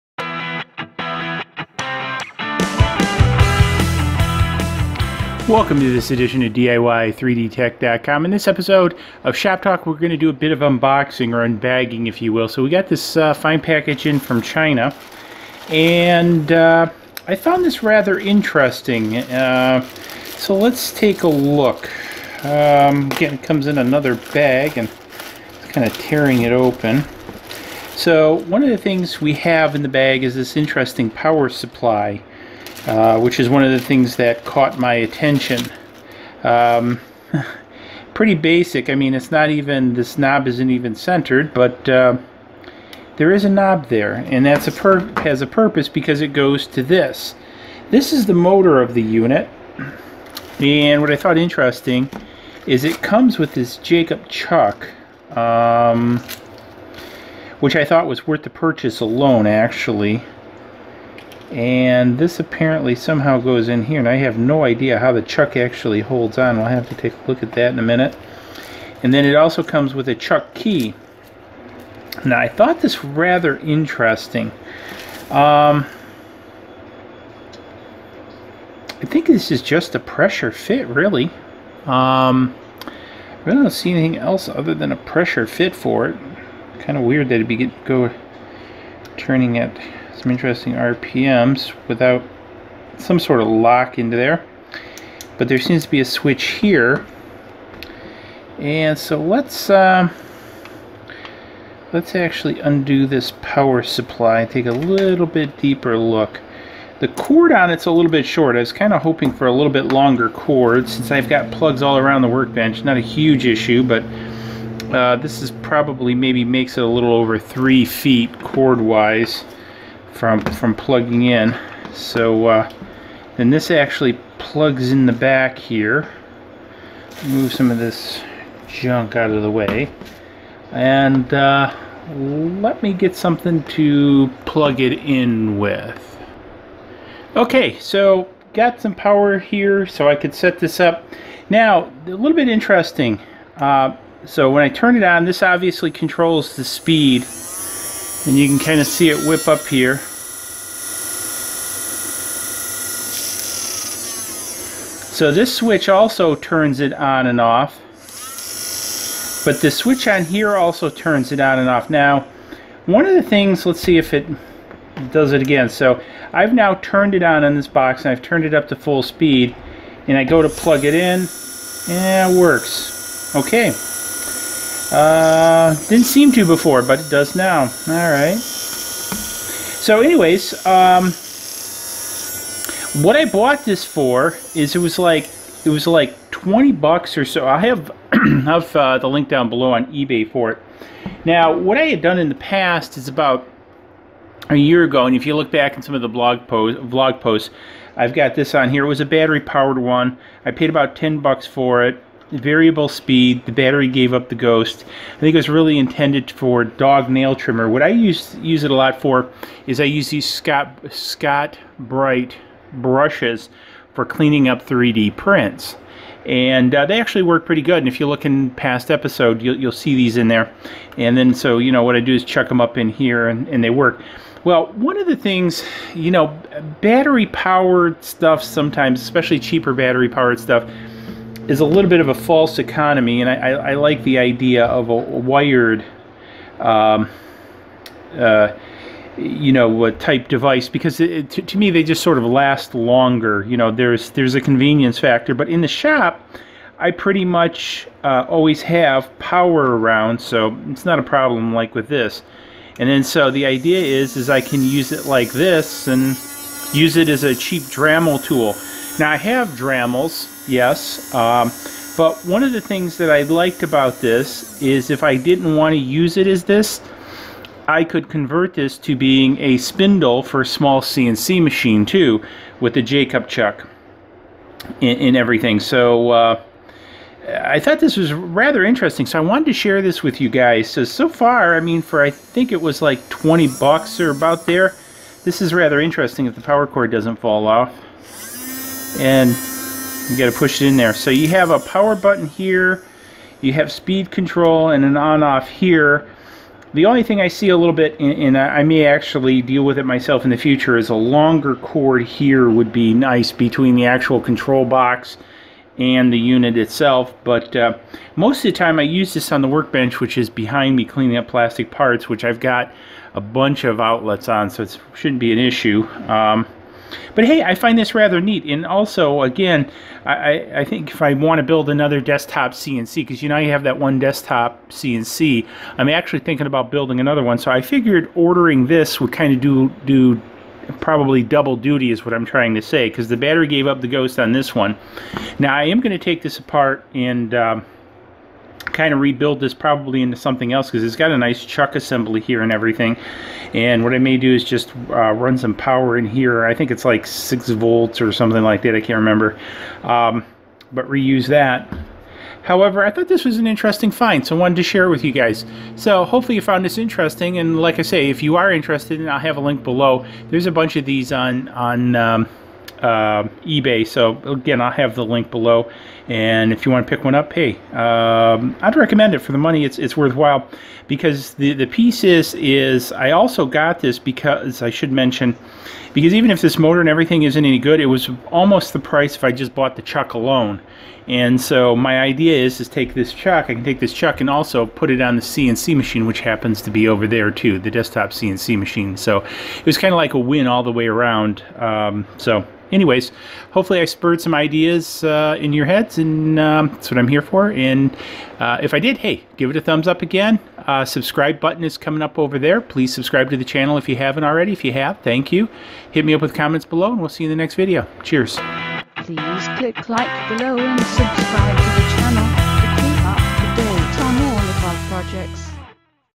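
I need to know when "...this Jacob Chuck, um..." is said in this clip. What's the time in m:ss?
0:53.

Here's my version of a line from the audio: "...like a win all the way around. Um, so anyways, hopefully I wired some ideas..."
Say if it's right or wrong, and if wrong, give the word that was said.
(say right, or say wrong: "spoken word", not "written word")
wrong: "spurred", not "wired".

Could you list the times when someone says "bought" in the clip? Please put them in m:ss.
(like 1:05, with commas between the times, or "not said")
3:03, 6:19.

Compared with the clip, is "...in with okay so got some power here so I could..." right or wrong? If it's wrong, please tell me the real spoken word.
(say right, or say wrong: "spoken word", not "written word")
right.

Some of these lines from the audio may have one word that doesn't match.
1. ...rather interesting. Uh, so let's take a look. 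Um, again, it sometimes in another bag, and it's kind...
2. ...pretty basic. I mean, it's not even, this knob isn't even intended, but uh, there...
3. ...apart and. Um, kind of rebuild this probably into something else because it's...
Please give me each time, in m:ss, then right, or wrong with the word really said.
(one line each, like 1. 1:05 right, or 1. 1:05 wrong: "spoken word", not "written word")
1. 0:17 wrong: "comes", not "sometimes"
2. 0:38 wrong: "centered", not "intended"
3. 5:36 right.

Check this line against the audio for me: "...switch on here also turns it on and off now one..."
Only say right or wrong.
right.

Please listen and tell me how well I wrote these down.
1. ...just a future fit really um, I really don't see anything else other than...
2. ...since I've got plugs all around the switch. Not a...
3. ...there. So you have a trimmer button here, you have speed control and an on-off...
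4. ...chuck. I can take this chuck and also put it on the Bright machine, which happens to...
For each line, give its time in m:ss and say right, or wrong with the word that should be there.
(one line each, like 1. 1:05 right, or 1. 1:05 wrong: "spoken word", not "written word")
1. 1:19 wrong: "pressure", not "future"
2. 1:50 wrong: "workbench", not "switch"
3. 4:50 wrong: "power", not "trimmer"
4. 6:23 wrong: "CNC", not "Bright".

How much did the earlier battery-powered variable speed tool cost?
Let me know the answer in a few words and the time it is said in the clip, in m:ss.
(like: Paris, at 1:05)
about $10, at 3:20.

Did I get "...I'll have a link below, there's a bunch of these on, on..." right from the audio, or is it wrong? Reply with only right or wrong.
right.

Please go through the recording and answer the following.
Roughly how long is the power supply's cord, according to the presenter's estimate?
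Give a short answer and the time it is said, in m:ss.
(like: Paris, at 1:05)
a little over 3 feet, at 1:56.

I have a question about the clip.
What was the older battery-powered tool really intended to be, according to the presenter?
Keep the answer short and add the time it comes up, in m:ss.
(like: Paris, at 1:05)
dog nail trimmer, at 3:26.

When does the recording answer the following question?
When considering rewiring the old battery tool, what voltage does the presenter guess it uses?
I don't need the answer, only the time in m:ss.
5:47.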